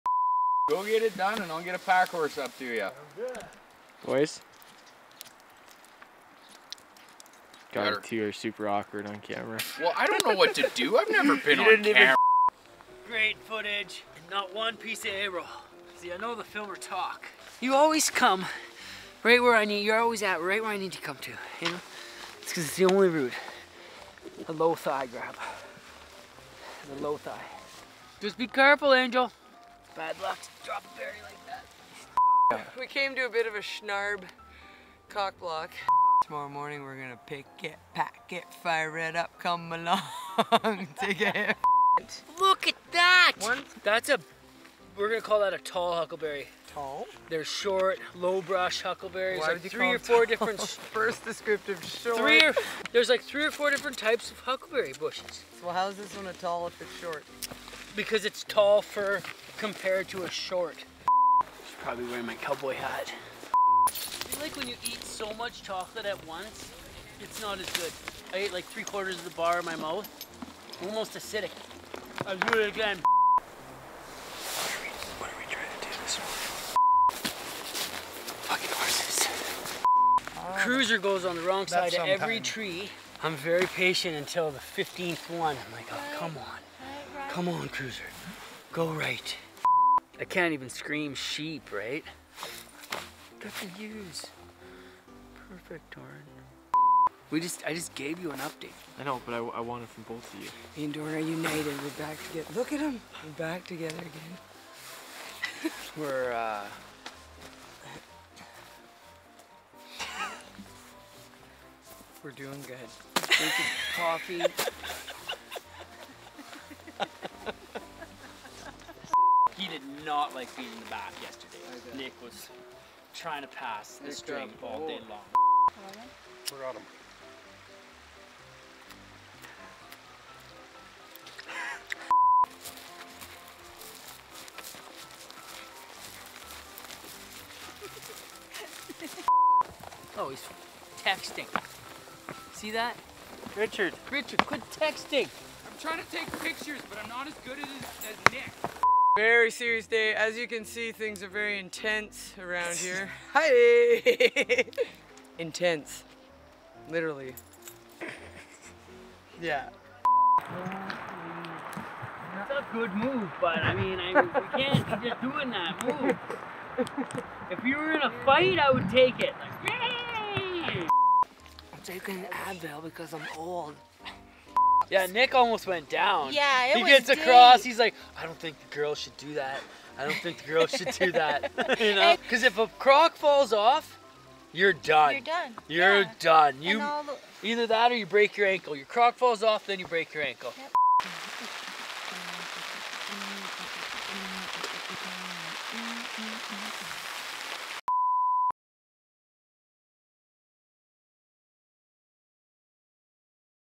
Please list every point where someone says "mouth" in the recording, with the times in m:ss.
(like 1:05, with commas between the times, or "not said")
1:09.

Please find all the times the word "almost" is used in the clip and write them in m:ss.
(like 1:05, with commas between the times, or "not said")
1:10, 2:55.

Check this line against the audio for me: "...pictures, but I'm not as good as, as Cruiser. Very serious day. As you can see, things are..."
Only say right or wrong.
wrong.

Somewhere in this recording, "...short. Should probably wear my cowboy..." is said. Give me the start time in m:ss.
1:00.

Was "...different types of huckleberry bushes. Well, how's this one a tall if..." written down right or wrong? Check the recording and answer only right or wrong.
right.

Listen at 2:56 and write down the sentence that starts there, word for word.
Yeah, it he was gets deep.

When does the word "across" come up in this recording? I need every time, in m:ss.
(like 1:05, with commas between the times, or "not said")
2:57.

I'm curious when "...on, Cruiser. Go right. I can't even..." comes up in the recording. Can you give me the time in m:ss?
1:27.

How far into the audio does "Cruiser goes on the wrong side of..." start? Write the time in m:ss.
1:20.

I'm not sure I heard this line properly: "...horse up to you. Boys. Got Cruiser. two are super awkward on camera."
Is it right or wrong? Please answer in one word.
wrong.